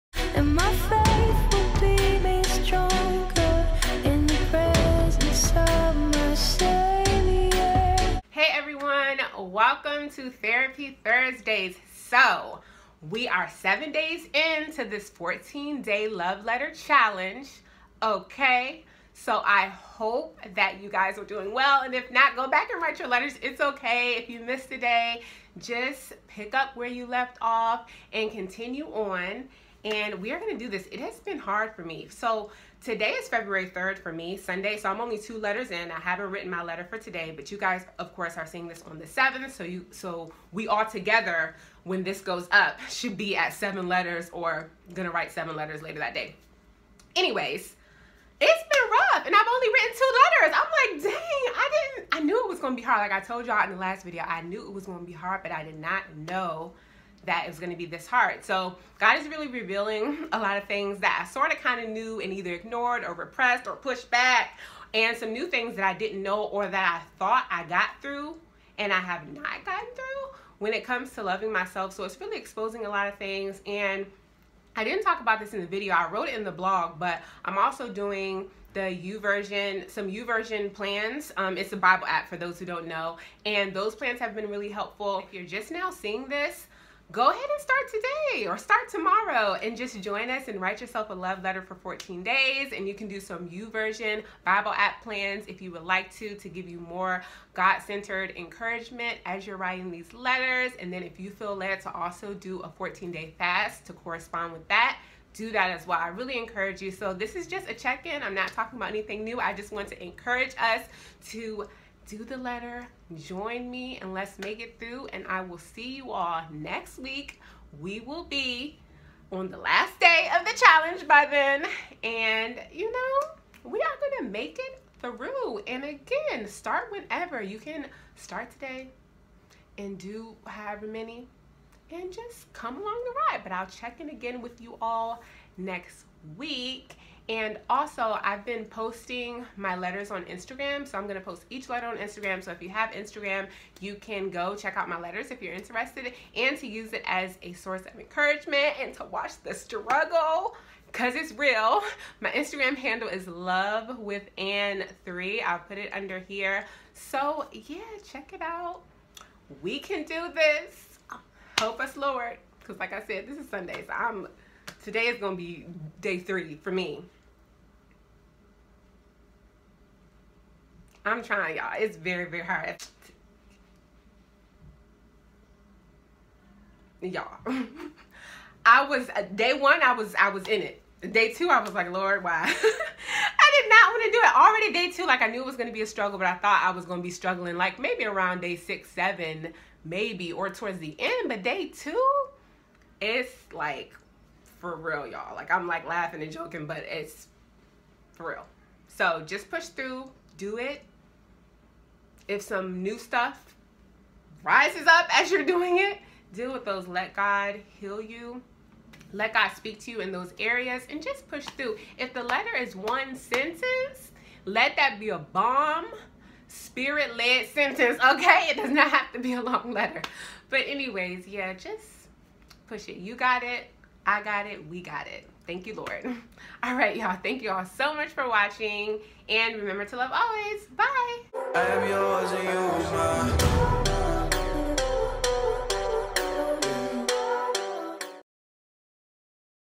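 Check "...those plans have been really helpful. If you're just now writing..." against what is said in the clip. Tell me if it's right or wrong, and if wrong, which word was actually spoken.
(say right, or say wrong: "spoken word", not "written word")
wrong: "seeing", not "writing".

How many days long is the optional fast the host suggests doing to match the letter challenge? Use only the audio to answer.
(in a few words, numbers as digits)
14.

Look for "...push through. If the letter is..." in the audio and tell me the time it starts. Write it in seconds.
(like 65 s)
211 s.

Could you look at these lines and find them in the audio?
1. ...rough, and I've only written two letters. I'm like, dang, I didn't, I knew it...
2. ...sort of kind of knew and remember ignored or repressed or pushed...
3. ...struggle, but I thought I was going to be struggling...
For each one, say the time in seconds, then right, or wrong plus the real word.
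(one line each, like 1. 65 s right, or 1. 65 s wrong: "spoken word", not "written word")
1. 48 s right
2. 61 s wrong: "either", not "remember"
3. 185 s right.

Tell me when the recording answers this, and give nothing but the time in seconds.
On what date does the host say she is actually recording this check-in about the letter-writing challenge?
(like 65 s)
33 s.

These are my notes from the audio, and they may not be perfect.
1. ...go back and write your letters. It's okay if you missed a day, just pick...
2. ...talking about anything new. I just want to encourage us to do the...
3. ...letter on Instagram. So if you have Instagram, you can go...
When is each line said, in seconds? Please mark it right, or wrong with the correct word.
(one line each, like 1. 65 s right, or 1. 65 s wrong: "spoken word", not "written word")
1. 22 s right
2. 108 s right
3. 141 s right.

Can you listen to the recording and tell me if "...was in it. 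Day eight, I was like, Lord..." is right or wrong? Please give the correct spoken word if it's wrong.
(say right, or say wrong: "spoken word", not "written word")
wrong: "two", not "eight".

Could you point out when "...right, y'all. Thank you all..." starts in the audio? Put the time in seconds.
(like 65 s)
226 s.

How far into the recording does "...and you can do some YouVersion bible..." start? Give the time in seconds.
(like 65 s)
92 s.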